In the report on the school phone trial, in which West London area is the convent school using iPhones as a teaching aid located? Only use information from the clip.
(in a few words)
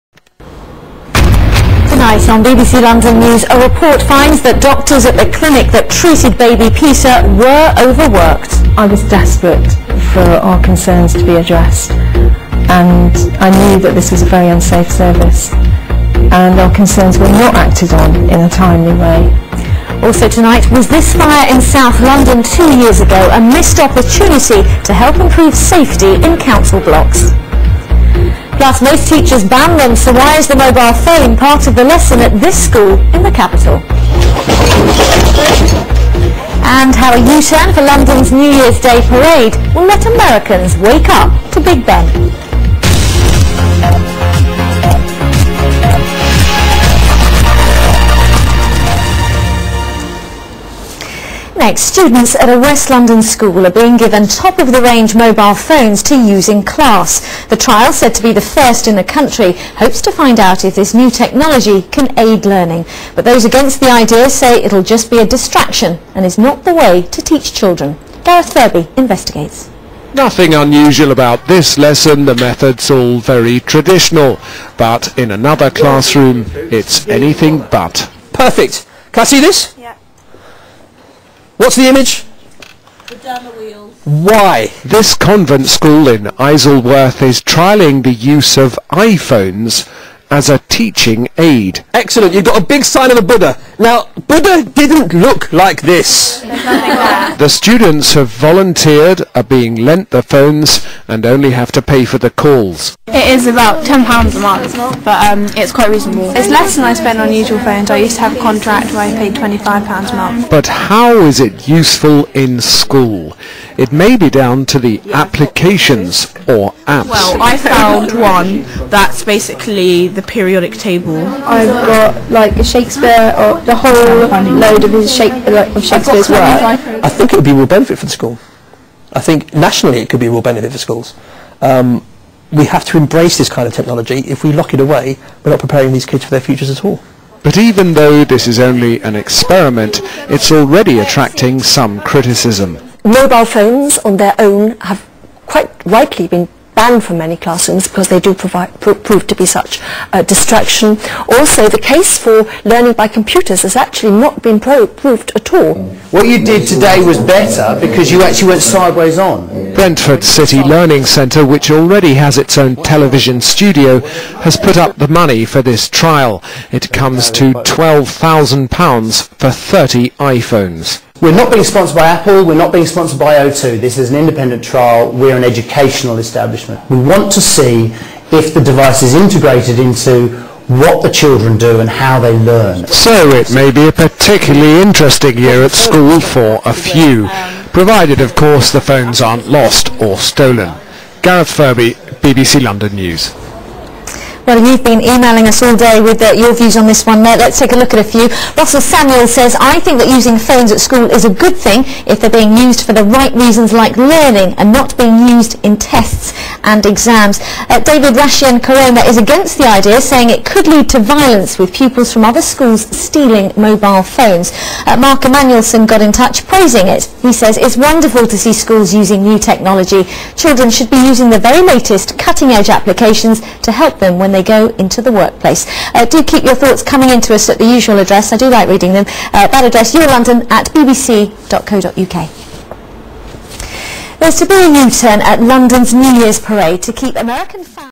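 Isleworth.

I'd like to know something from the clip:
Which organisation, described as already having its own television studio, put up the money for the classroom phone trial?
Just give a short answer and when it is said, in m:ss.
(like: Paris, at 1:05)
Brentford City Learning Centre, at 2:39.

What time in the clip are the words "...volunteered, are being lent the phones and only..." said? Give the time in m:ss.
1:38.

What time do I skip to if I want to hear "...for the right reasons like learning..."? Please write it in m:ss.
3:22.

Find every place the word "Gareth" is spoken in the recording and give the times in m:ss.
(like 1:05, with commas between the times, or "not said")
1:08, 3:11.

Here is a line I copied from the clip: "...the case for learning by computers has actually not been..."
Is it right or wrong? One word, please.
right.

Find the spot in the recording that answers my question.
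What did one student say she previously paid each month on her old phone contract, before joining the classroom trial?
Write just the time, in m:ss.
1:49.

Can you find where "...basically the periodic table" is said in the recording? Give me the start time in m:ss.
1:59.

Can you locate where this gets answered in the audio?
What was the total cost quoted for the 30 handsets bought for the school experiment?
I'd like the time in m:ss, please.
2:47.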